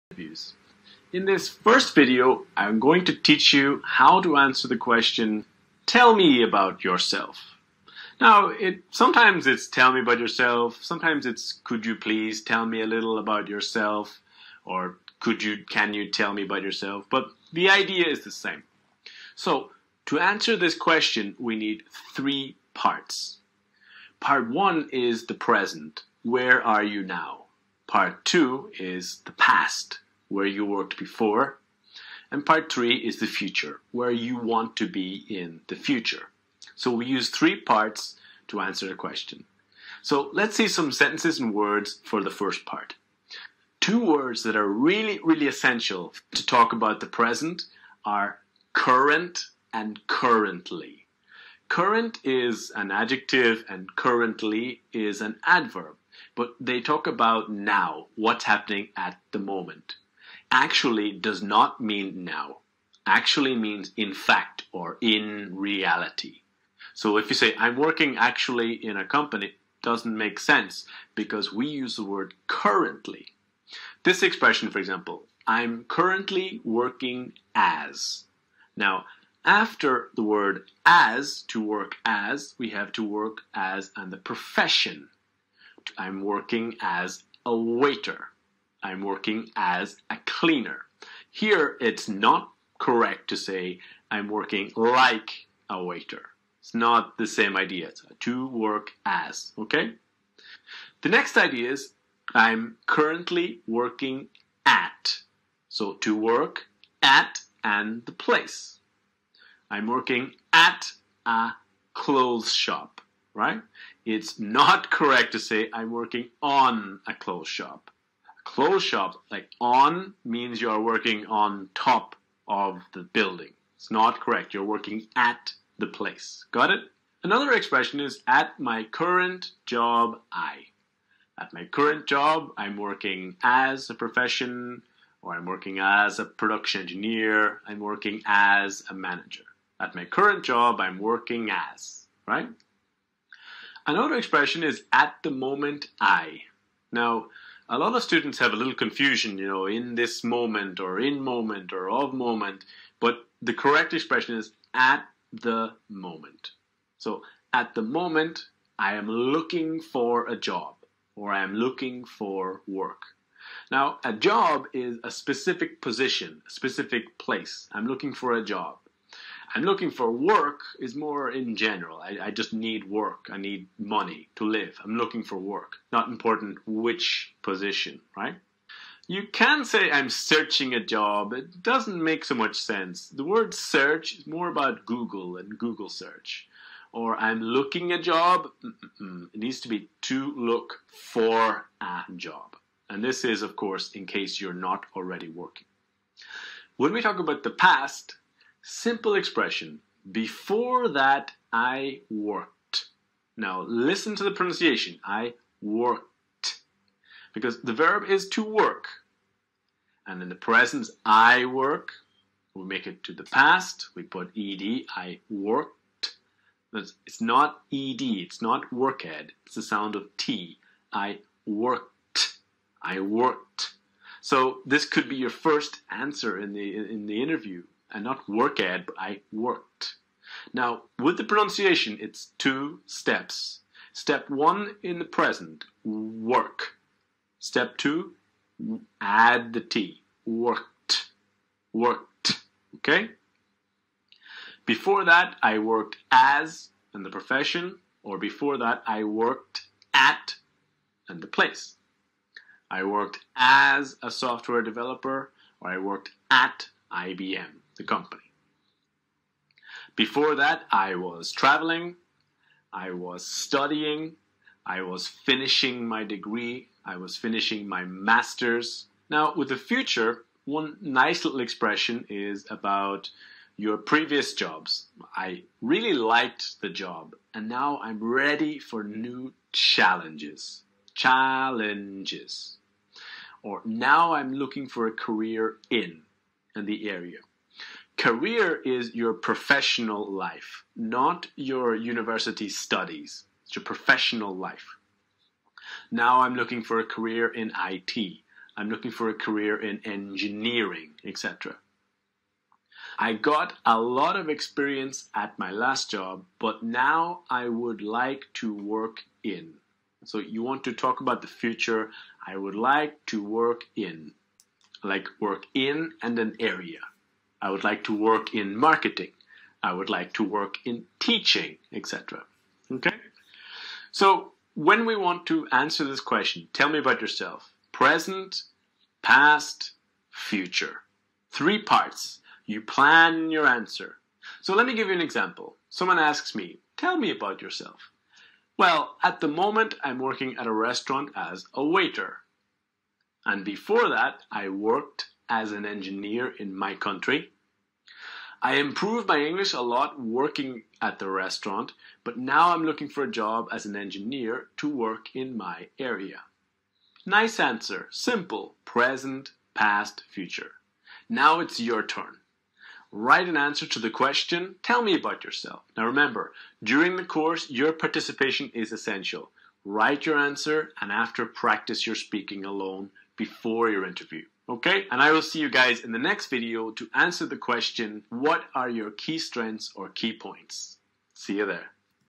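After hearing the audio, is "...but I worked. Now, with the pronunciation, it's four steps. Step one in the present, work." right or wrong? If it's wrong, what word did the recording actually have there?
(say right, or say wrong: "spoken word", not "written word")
wrong: "two", not "four".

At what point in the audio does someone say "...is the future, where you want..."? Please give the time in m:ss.
0:32.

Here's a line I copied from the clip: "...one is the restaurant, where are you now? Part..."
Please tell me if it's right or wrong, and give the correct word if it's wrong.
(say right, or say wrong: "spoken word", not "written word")
wrong: "present", not "restaurant".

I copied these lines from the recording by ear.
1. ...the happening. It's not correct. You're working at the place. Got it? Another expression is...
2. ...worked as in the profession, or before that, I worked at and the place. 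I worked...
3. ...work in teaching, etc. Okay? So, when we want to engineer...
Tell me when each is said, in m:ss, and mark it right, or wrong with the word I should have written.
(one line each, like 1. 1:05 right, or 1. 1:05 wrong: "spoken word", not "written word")
1. 2:02 wrong: "building", not "happening"
2. 4:05 right
3. 5:20 wrong: "answer", not "engineer".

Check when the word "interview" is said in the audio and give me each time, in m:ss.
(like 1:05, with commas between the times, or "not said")
3:47, 6:13.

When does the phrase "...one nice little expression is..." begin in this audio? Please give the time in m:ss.
4:30.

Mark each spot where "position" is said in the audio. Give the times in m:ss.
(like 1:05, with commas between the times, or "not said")
2:45, 2:57.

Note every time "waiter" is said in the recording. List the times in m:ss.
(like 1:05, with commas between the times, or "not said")
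1:27, 1:35, 5:41.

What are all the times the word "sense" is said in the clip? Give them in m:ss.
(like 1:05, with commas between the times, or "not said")
1:10, 3:02.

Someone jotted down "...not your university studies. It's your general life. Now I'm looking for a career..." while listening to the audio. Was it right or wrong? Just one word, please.
wrong.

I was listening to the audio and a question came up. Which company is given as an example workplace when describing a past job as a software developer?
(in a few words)
IBM.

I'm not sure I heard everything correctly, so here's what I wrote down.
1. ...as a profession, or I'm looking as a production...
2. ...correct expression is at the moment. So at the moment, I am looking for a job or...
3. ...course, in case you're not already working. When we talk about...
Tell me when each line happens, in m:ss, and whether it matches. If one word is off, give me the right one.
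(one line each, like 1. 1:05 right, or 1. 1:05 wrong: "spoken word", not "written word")
1. 2:13 wrong: "working", not "looking"
2. 2:33 right
3. 3:13 right.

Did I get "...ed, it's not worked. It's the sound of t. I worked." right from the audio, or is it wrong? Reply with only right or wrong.
right.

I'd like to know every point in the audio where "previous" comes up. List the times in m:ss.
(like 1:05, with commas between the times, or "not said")
4:33.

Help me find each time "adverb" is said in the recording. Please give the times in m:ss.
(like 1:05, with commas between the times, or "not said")
0:55.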